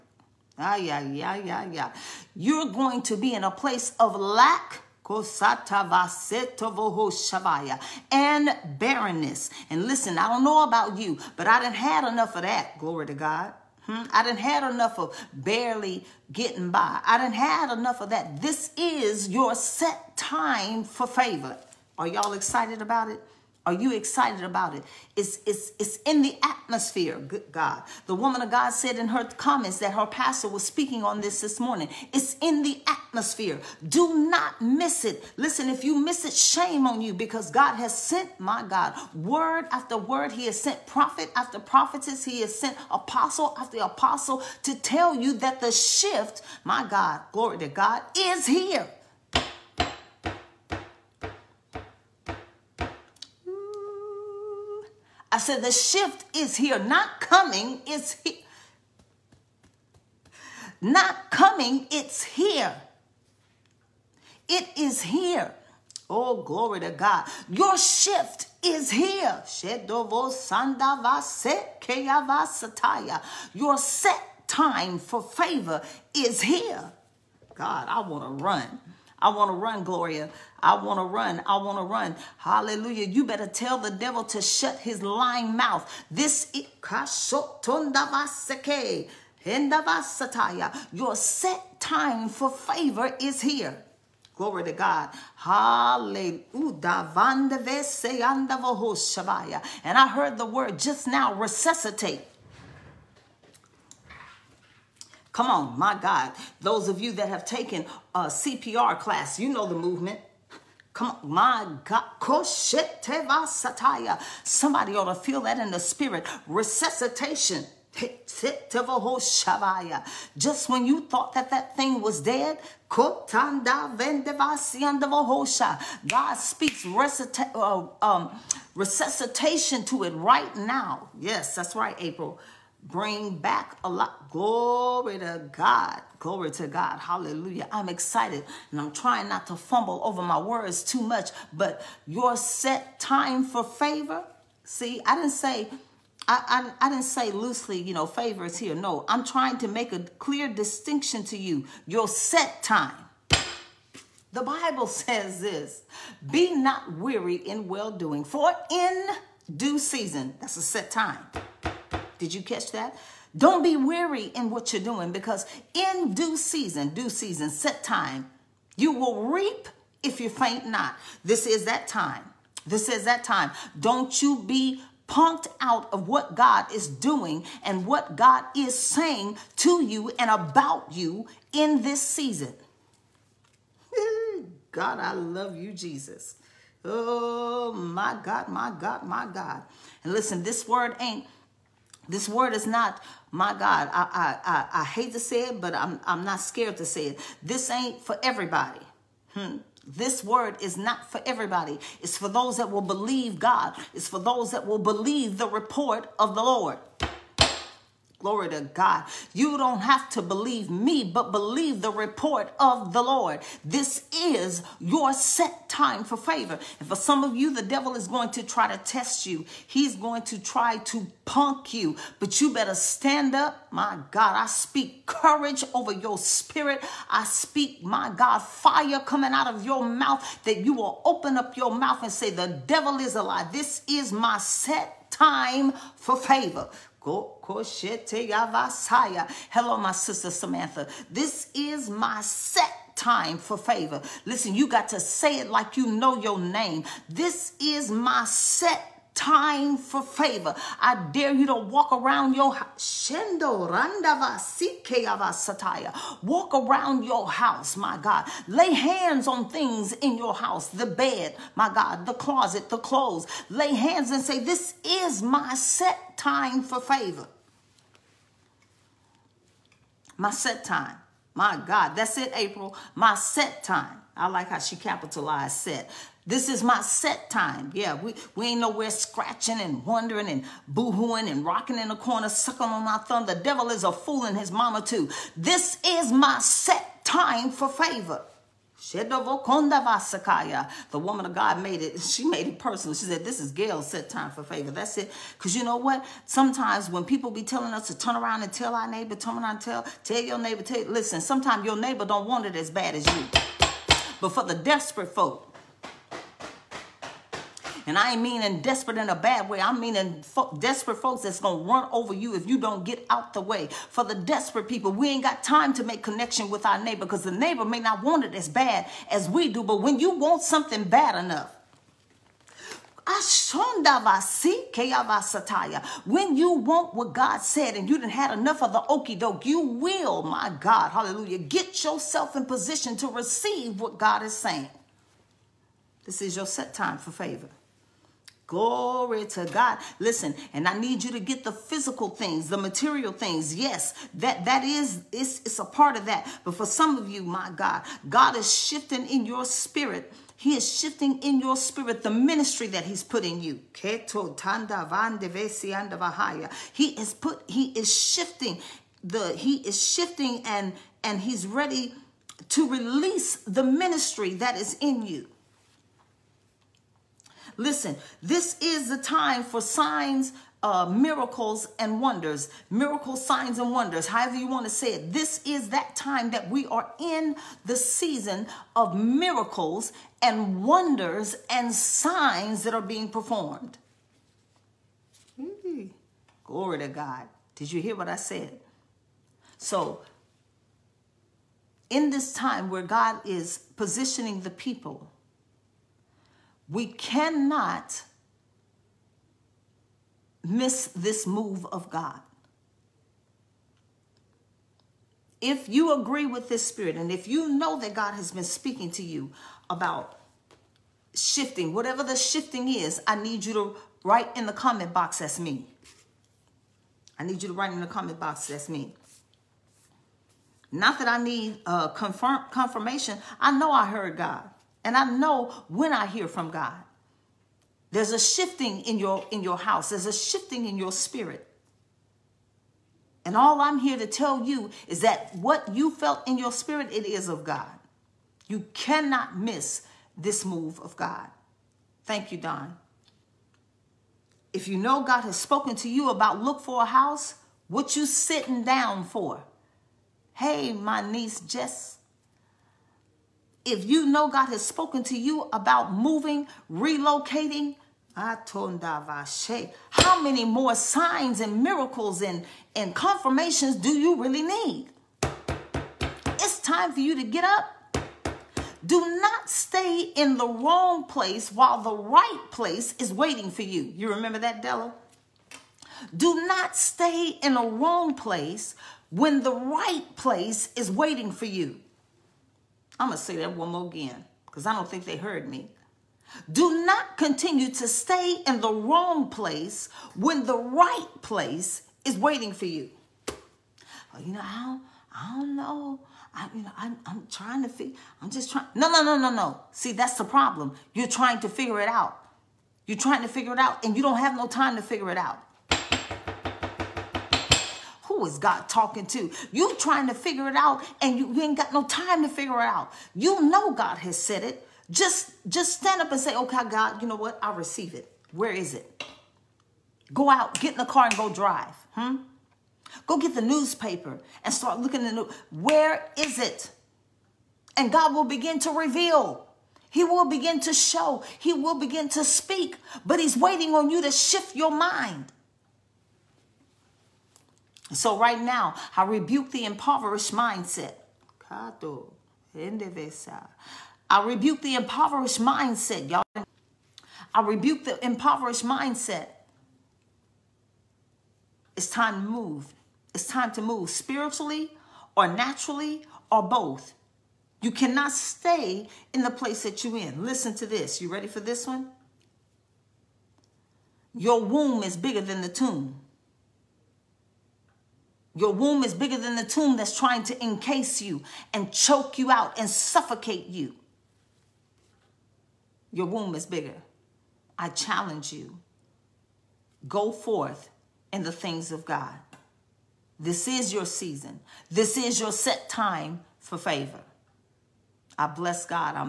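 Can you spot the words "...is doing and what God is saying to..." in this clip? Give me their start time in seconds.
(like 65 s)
176 s.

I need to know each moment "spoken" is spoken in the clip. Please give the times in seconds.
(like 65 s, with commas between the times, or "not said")
445 s, 454 s.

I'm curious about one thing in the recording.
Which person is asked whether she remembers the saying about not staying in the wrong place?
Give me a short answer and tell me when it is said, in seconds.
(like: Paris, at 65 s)
Della, at 474 s.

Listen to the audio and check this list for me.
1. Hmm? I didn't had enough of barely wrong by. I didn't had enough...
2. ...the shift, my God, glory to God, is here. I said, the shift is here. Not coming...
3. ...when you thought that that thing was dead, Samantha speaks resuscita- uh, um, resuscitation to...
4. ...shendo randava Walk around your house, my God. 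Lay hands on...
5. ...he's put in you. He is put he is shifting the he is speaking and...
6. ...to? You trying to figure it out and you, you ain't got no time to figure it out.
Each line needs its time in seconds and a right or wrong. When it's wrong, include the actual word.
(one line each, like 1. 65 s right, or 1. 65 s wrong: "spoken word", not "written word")
1. 13 s wrong: "getting", not "wrong"
2. 45 s right
3. 120 s wrong: "God", not "Samantha"
4. 252 s right
5. 352 s wrong: "shifting", not "speaking"
6. 509 s right.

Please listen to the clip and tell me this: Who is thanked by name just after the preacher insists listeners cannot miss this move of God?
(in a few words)
Don.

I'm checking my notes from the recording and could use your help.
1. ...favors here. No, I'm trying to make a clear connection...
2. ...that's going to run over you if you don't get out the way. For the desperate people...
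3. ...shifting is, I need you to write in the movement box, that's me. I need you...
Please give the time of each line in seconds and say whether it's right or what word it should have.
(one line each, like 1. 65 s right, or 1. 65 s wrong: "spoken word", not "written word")
1. 148 s wrong: "distinction", not "connection"
2. 311 s right
3. 412 s wrong: "comment", not "movement".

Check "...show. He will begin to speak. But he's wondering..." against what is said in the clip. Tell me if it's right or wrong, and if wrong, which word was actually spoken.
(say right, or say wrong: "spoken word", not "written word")
wrong: "waiting", not "wondering".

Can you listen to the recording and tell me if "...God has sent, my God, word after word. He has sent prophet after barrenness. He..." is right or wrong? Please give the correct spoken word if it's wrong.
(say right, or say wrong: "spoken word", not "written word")
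wrong: "prophetess", not "barrenness".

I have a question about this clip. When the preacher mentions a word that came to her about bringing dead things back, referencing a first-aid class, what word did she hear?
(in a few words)
resuscitate.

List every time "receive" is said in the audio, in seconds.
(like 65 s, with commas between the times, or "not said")
333 s, 517 s.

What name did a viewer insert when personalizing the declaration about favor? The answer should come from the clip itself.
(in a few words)
Gail.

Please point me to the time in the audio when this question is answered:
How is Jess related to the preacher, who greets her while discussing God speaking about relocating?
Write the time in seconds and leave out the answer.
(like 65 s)
451 s.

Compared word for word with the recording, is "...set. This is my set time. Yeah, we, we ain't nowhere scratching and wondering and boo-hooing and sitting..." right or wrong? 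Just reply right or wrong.
wrong.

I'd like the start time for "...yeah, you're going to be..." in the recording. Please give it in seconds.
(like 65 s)
1 s.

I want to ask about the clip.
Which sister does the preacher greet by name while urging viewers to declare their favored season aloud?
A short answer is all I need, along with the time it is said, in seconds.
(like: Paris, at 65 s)
Samantha, at 240 s.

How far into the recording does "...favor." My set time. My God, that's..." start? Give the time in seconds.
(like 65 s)
266 s.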